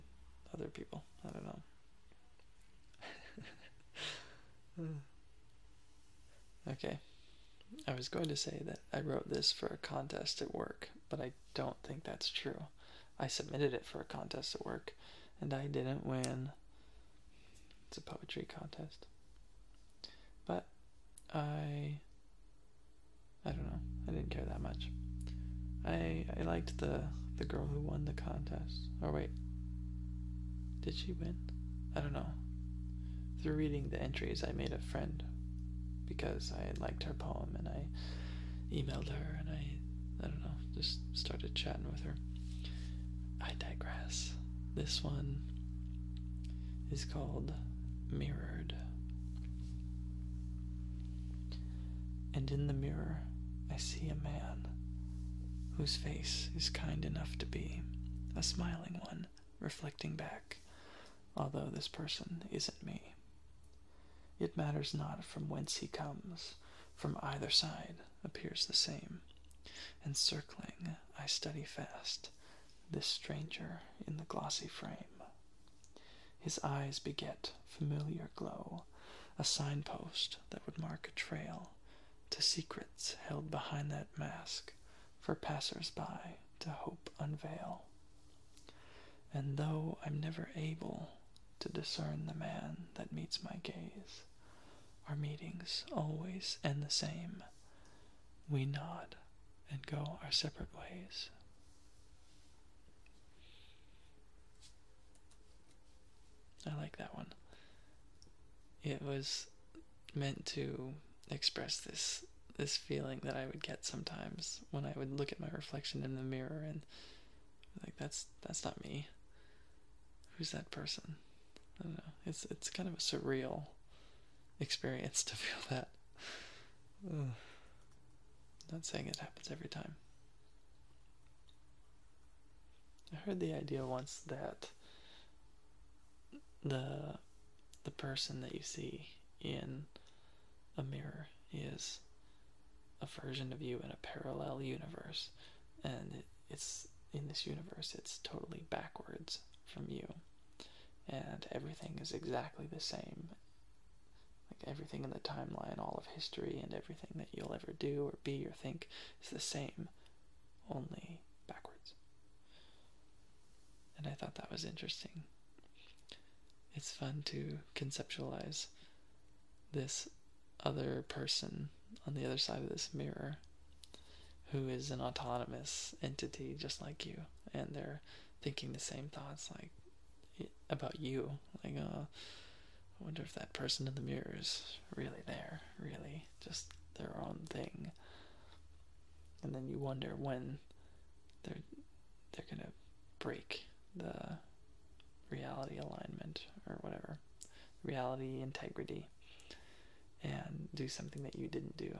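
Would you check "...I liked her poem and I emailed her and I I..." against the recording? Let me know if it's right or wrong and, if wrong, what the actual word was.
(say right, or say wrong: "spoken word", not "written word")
right.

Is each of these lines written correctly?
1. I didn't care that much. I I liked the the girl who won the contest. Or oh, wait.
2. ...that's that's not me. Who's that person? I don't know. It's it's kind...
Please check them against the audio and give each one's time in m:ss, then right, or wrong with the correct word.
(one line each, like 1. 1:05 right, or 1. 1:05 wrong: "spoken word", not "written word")
1. 0:24 right
2. 1:57 right.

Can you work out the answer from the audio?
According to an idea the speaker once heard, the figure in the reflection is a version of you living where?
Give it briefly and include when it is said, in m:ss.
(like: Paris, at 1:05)
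A parallel universe, at 2:24.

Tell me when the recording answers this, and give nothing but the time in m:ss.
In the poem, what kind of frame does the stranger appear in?
1:14.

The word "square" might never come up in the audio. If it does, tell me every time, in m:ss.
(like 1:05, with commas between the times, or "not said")
not said.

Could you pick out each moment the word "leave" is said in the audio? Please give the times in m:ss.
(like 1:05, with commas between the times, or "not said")
not said.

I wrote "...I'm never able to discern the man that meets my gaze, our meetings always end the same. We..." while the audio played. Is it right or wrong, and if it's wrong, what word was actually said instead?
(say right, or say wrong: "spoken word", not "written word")
right.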